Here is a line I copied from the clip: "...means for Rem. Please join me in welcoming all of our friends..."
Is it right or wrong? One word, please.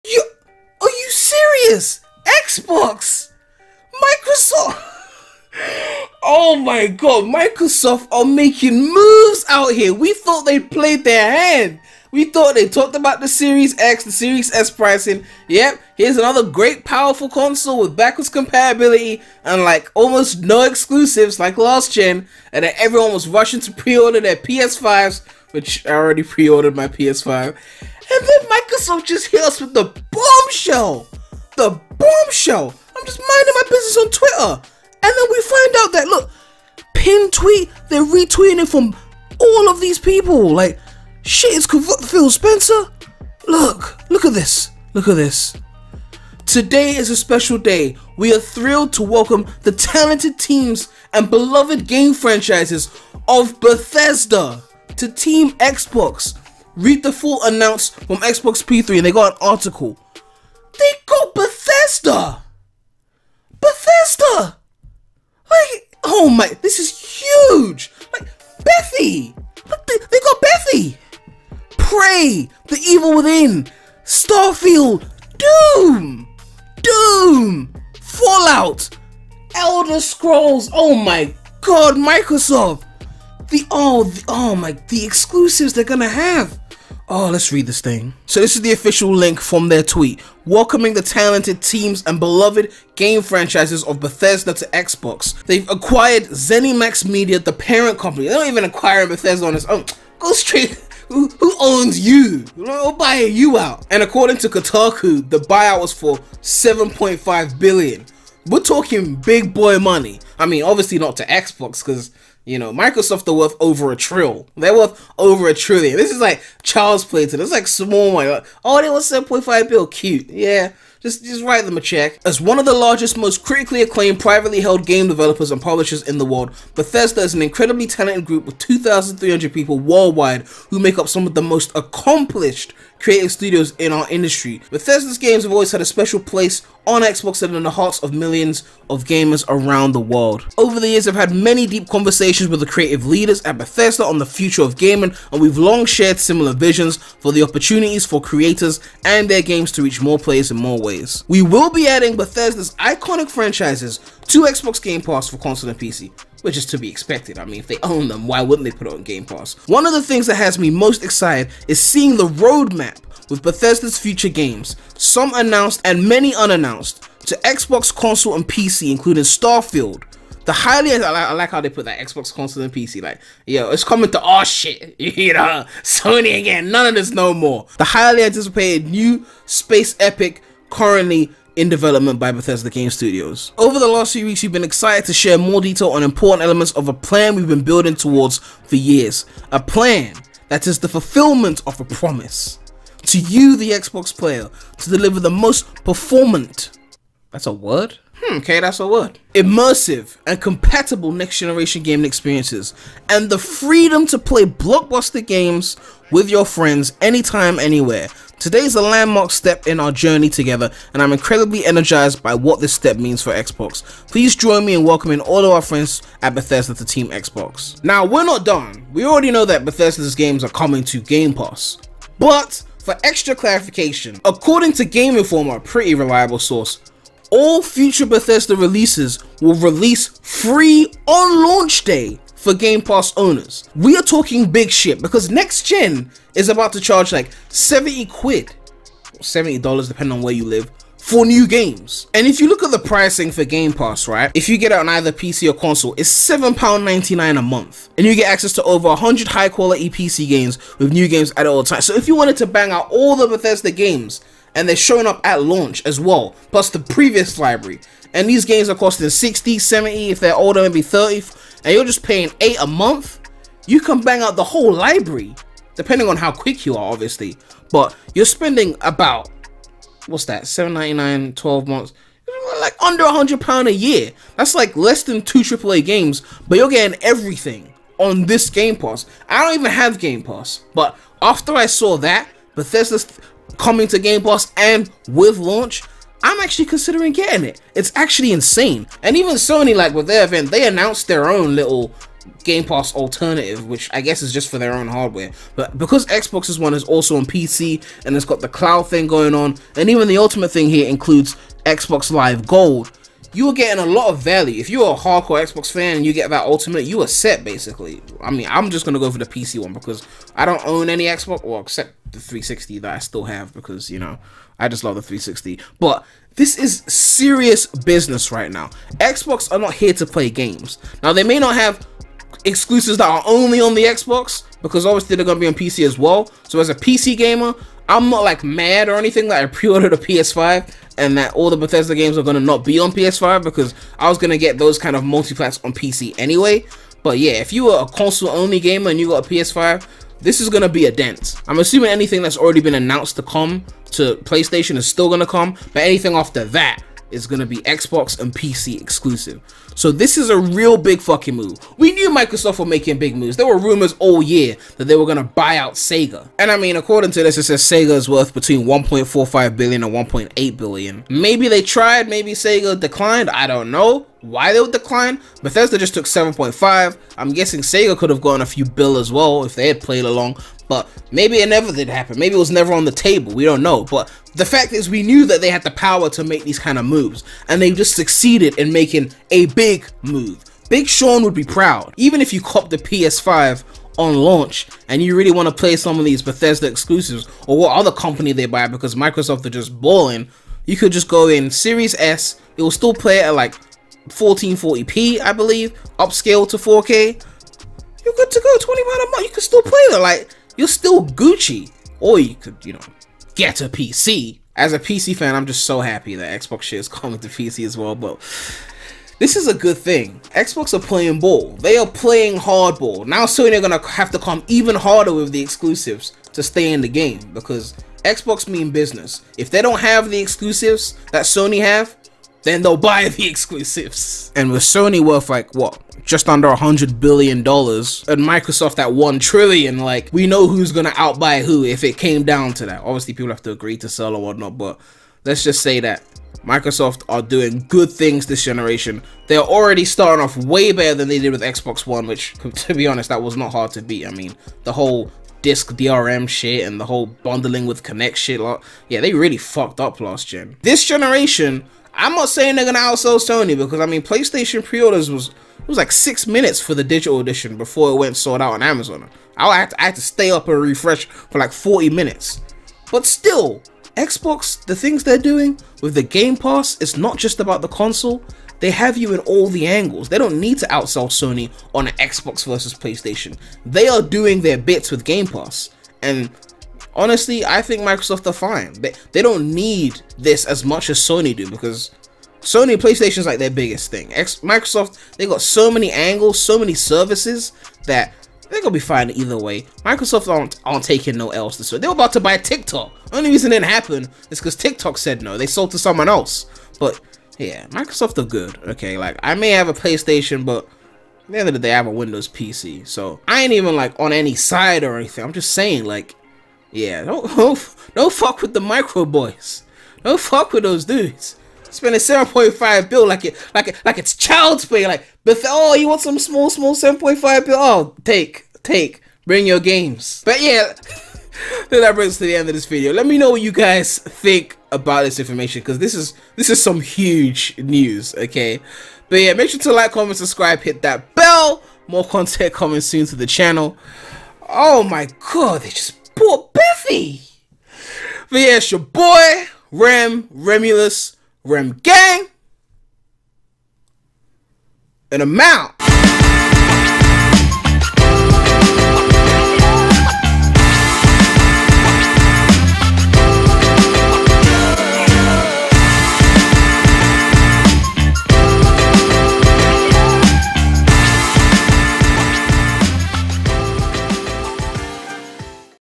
wrong.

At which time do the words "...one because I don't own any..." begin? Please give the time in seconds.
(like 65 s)
309 s.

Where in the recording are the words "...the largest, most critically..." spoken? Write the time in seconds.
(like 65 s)
122 s.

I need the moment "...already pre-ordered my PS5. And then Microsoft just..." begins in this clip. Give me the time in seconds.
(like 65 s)
25 s.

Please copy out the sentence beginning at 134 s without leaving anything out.
Bethesda's games have always had a special place on Xbox and in the hearts of millions of gamers around the world.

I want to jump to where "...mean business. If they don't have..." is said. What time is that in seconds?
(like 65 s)
418 s.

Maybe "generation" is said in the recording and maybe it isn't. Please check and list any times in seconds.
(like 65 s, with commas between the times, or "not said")
201 s, 438 s, 450 s.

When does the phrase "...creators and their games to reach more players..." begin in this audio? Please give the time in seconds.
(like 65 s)
148 s.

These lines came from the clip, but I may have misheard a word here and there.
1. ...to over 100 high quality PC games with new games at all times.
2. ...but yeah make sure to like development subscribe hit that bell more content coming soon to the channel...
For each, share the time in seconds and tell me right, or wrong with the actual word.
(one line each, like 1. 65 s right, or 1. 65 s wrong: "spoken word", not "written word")
1. 248 s right
2. 529 s wrong: "comment", not "development".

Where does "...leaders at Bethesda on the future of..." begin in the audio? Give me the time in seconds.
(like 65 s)
143 s.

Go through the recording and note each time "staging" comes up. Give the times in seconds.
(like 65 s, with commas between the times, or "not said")
not said.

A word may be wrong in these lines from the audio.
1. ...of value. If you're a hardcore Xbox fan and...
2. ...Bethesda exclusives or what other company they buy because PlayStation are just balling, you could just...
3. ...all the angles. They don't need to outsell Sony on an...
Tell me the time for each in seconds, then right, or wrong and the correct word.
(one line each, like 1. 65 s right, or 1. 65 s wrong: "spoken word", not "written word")
1. 304 s right
2. 386 s wrong: "Microsoft", not "PlayStation"
3. 469 s right.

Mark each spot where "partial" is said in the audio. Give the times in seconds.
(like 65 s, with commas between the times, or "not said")
not said.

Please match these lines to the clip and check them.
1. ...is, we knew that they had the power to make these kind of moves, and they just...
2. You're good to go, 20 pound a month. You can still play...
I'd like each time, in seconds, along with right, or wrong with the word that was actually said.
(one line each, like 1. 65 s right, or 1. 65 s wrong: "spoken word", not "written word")
1. 374 s right
2. 398 s right.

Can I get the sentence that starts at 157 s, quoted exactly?
I mean, if they own them, why wouldn't they put it on Game Pass?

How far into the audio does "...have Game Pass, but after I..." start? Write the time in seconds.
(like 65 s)
279 s.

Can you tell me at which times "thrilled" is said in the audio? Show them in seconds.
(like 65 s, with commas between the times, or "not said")
48 s.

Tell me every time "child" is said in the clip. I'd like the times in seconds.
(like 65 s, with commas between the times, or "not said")
514 s.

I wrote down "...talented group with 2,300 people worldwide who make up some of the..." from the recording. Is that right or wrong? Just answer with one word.
right.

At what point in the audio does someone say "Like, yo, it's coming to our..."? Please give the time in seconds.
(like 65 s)
173 s.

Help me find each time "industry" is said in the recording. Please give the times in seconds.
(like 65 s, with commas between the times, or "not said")
134 s.